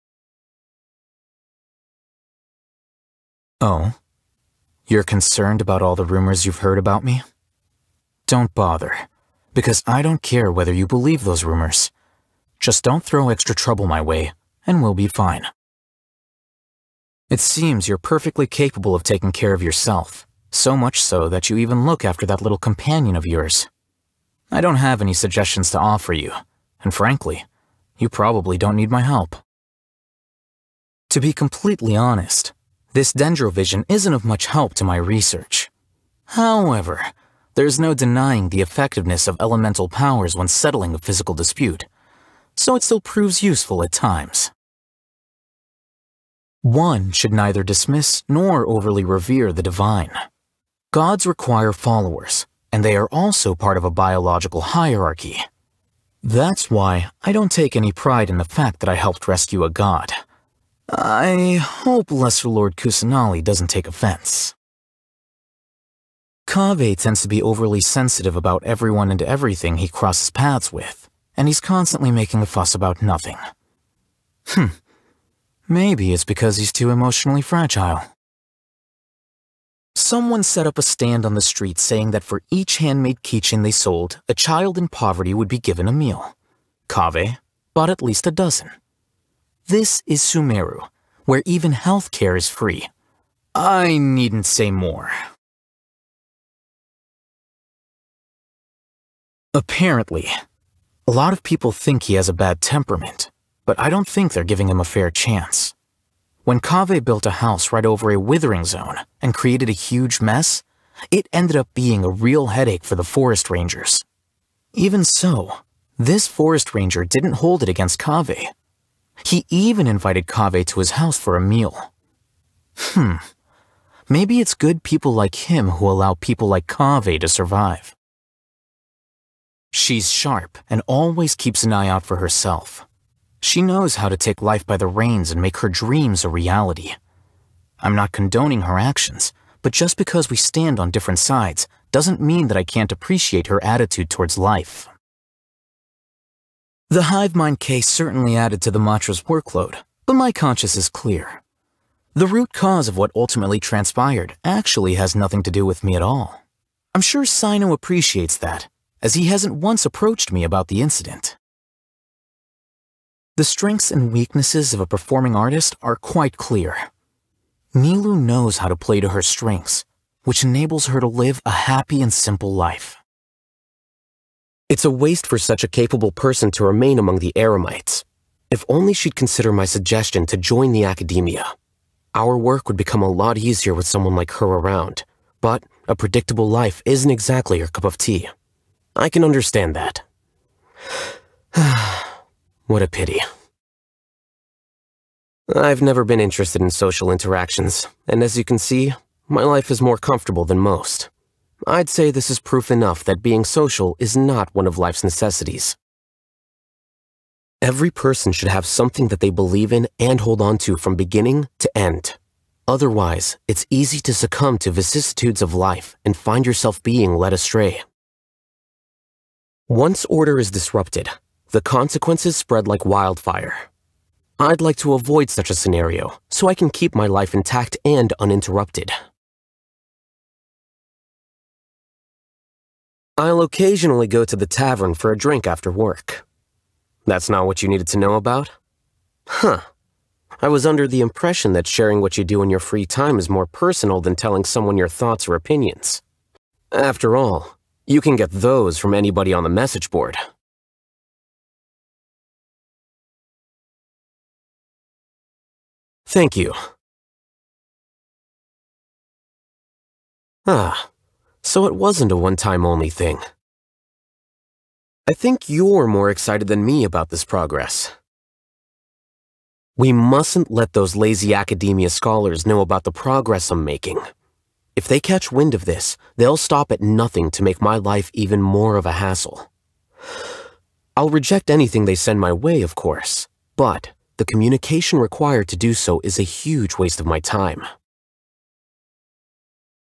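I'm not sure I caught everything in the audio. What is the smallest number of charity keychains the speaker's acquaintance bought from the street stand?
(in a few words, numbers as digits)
12.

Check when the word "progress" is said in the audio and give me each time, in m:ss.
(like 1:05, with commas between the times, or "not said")
4:27, 4:32.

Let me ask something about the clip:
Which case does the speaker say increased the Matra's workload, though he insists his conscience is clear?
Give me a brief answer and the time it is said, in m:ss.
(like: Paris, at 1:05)
The hive mind case, at 2:27.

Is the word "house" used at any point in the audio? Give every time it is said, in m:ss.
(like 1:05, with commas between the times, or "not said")
1:47, 2:00.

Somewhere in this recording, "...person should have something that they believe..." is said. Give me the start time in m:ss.
3:27.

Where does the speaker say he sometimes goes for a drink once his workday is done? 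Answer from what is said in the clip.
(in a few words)
The tavern.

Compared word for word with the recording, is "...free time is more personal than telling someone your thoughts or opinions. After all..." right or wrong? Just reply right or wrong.
right.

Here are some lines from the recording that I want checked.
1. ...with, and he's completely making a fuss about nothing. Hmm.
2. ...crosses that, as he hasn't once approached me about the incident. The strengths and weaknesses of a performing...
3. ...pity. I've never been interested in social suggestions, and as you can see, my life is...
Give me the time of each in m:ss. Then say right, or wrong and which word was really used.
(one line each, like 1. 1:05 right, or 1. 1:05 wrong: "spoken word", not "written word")
1. 1:10 wrong: "constantly", not "completely"
2. 2:37 wrong: "appreciates", not "crosses"
3. 3:12 wrong: "interactions", not "suggestions".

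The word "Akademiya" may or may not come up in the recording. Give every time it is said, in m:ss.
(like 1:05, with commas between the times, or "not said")
3:00, 4:31.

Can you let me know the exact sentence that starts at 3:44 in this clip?
I'd like to avoid such a scenario so I can keep my life intact and uninterrupted.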